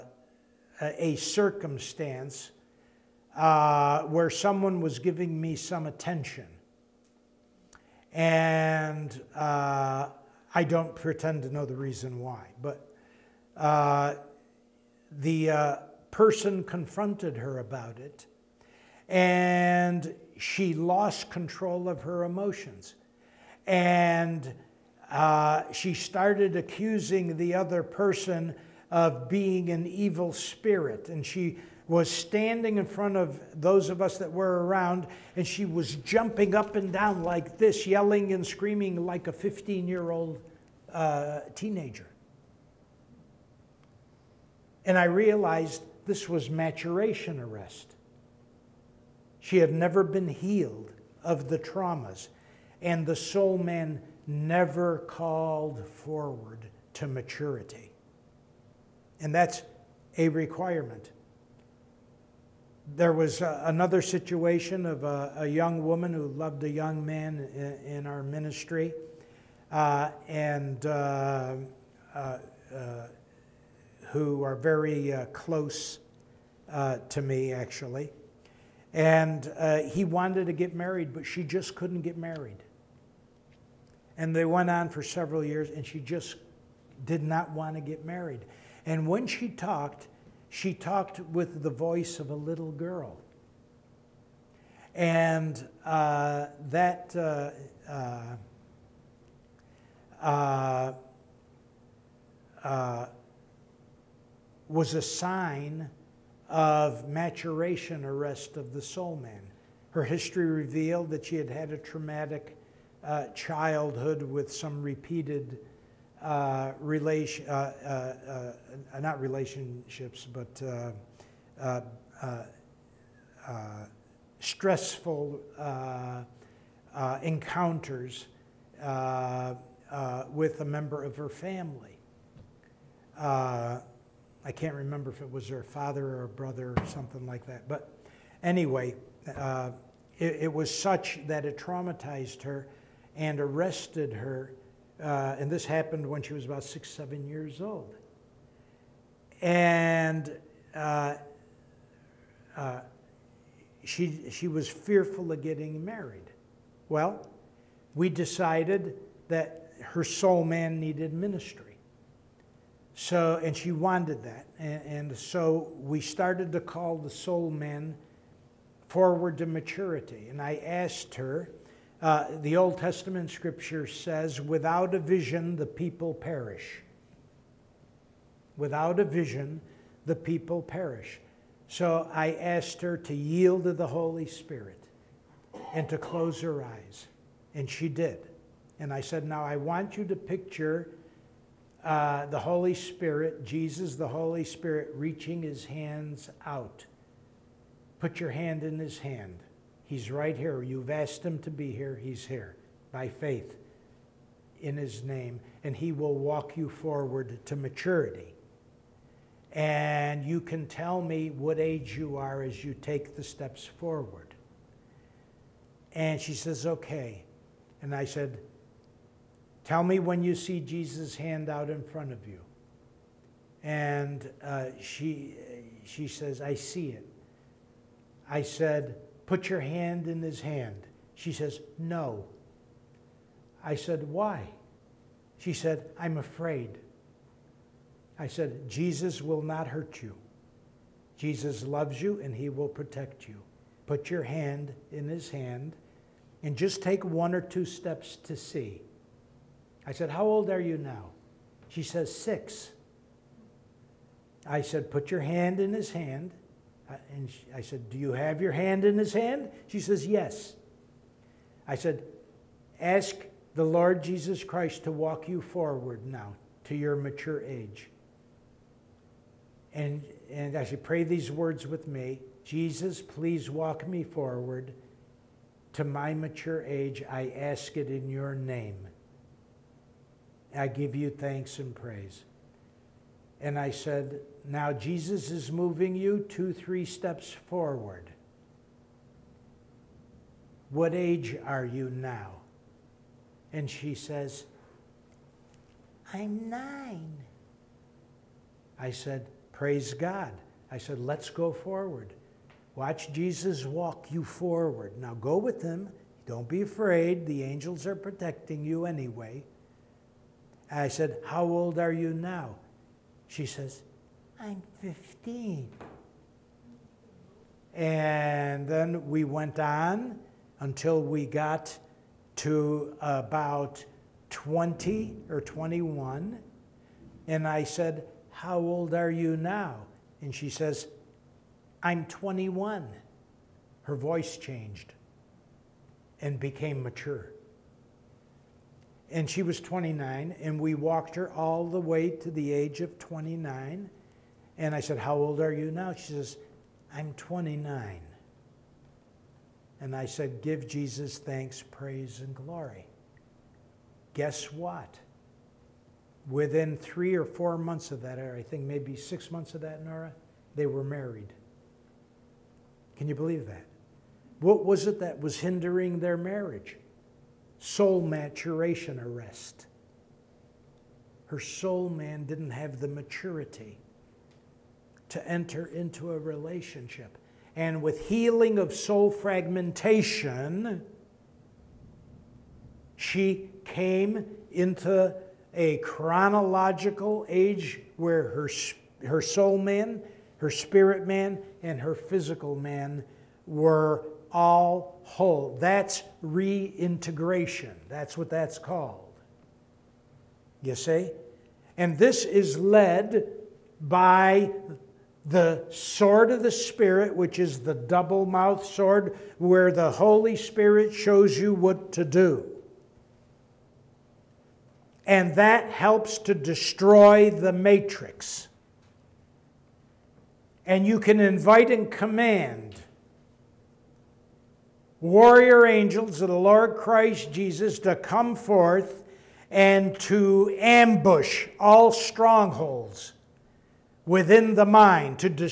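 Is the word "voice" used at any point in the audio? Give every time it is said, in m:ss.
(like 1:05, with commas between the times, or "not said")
1:31, 5:33.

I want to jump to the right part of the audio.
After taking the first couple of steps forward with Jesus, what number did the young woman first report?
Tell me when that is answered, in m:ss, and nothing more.
4:56.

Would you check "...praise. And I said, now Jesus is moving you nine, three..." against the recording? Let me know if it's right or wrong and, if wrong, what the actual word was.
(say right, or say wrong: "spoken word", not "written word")
wrong: "two", not "nine".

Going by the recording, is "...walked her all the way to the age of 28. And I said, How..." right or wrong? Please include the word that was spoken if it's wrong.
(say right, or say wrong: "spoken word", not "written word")
wrong: "29", not "28".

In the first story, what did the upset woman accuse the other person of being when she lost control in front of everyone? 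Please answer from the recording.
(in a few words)
an evil spirit.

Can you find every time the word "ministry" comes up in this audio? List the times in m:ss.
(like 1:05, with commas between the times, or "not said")
1:08, 2:41.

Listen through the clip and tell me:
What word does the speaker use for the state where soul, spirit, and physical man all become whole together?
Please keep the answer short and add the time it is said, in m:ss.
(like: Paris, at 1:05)
reintegration, at 6:36.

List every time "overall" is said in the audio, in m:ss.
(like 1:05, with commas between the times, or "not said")
not said.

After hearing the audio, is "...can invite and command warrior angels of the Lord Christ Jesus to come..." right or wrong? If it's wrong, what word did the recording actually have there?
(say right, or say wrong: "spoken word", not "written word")
right.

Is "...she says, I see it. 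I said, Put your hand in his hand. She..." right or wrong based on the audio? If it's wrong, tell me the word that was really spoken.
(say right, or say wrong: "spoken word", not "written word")
right.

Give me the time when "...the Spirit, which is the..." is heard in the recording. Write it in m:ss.
6:46.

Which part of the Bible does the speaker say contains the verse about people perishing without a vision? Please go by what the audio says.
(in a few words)
Old Testament.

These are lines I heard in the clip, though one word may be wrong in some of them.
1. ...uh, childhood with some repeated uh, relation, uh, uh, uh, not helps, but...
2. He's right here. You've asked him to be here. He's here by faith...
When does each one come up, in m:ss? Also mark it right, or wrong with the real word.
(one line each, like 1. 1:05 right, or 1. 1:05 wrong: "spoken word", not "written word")
1. 1:53 wrong: "relationships", not "helps"
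2. 3:19 right.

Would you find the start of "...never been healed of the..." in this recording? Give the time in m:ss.
0:49.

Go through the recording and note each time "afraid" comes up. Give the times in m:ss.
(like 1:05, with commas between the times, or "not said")
3:56, 5:06.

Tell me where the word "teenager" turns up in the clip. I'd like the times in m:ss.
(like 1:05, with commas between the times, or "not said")
0:41.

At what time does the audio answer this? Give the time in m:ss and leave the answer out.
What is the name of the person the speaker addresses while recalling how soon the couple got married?
5:59.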